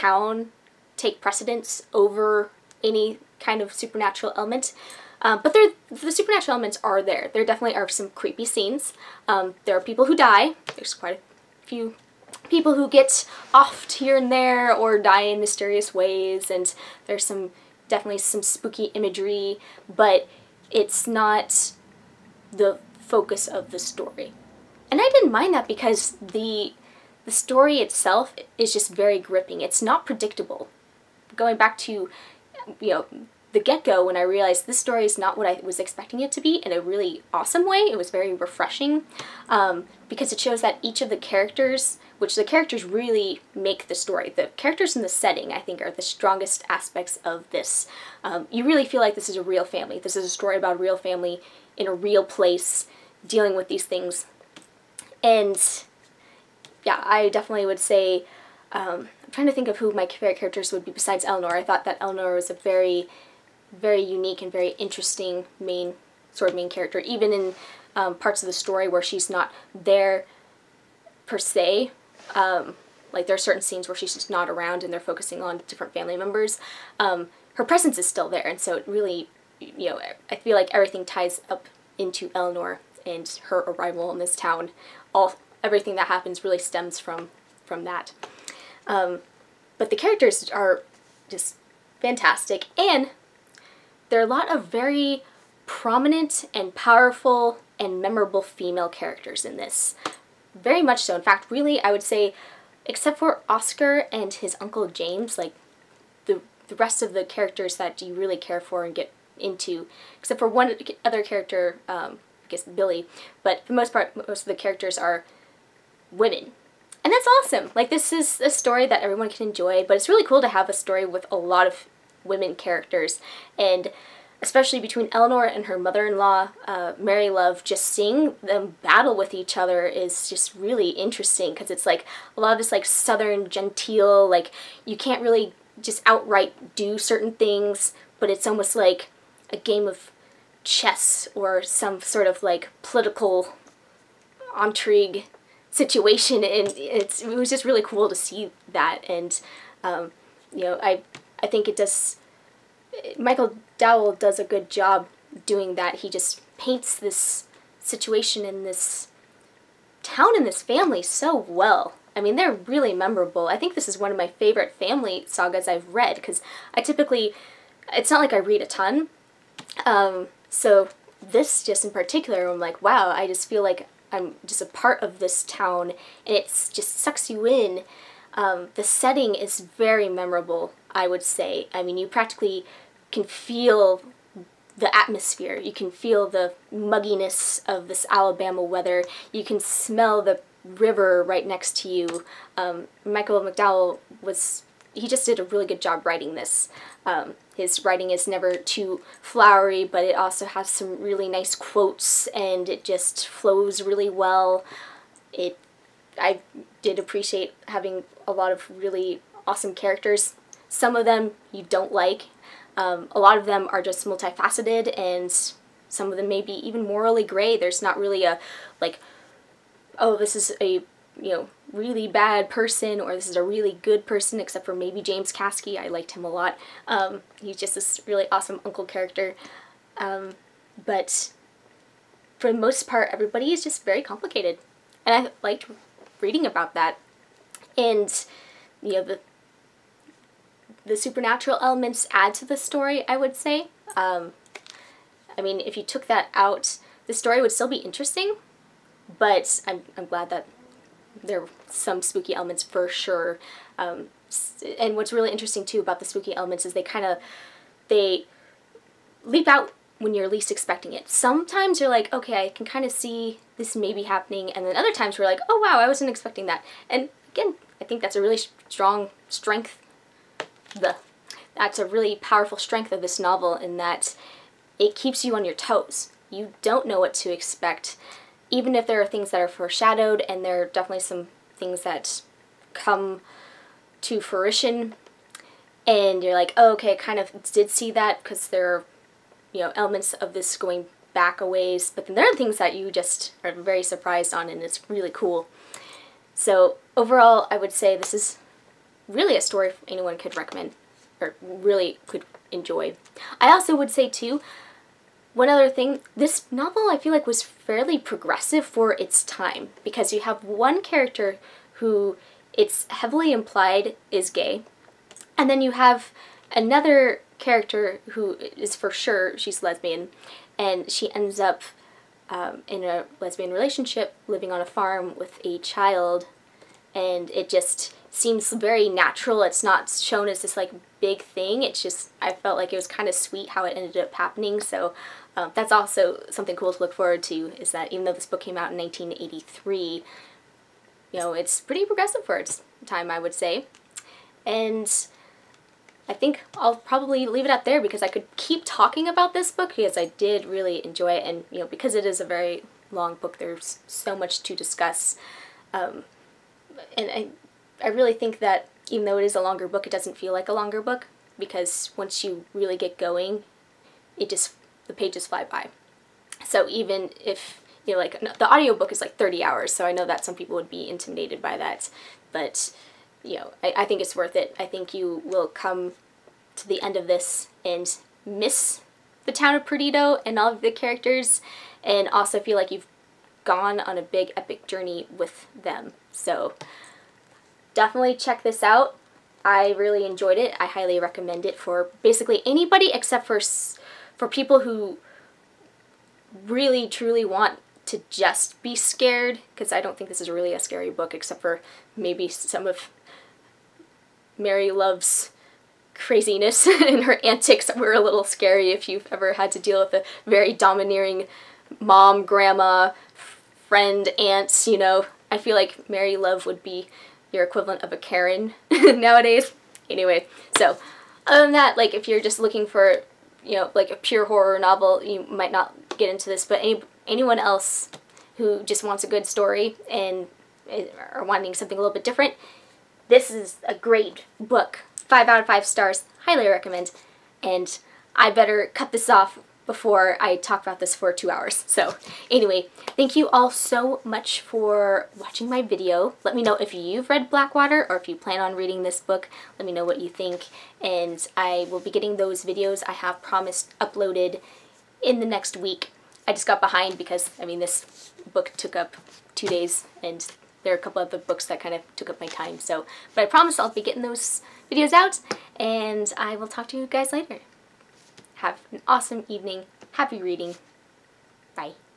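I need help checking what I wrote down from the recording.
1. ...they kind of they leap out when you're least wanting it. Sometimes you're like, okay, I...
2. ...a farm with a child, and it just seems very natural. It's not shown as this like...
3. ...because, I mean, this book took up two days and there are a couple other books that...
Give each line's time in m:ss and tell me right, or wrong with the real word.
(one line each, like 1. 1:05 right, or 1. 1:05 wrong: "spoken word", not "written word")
1. 4:16 wrong: "expecting", not "wanting"
2. 5:24 right
3. 7:36 right.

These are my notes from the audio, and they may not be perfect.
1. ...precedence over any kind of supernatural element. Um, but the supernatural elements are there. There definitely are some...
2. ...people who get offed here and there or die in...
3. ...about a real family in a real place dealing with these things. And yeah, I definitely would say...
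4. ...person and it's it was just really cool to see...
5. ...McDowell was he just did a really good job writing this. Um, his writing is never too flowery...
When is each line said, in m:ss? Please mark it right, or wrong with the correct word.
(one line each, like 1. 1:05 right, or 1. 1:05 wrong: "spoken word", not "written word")
1. 0:01 right
2. 0:12 right
3. 0:50 right
4. 2:25 wrong: "situation", not "person"
5. 3:13 right.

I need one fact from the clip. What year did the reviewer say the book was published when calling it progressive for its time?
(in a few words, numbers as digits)
1983.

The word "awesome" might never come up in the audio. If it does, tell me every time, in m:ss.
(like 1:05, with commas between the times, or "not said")
0:37, 1:57, 3:29, 3:48, 7:48.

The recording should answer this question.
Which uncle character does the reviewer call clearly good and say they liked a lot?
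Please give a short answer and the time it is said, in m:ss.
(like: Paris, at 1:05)
James Caskey, at 3:45.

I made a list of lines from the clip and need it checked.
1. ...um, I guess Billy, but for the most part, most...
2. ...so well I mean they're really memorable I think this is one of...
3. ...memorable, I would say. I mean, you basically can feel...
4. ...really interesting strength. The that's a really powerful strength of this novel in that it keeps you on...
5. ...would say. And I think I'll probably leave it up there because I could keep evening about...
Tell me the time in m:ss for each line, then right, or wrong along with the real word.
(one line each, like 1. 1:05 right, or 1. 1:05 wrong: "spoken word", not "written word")
1. 1:51 right
2. 2:41 right
3. 3:00 wrong: "practically", not "basically"
4. 4:28 wrong: "strong", not "interesting"
5. 5:43 wrong: "talking", not "evening".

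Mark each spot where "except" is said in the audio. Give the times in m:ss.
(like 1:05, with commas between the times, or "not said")
1:42, 1:50, 3:44, 6:32, 6:41.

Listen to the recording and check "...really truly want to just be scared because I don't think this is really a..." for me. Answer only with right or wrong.
right.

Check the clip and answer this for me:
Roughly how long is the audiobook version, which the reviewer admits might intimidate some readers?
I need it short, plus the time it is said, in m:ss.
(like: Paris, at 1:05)
30 hours, at 6:09.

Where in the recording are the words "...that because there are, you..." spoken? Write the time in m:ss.
4:47.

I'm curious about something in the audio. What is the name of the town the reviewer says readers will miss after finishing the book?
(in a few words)
Perdido.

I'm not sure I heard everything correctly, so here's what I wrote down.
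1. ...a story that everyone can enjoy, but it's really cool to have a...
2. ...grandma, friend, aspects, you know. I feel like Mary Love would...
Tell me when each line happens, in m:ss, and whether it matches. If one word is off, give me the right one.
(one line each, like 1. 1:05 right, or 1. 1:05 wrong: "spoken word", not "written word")
1. 1:58 right
2. 6:52 wrong: "aunts", not "aspects".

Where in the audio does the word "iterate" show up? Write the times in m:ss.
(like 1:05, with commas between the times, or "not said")
not said.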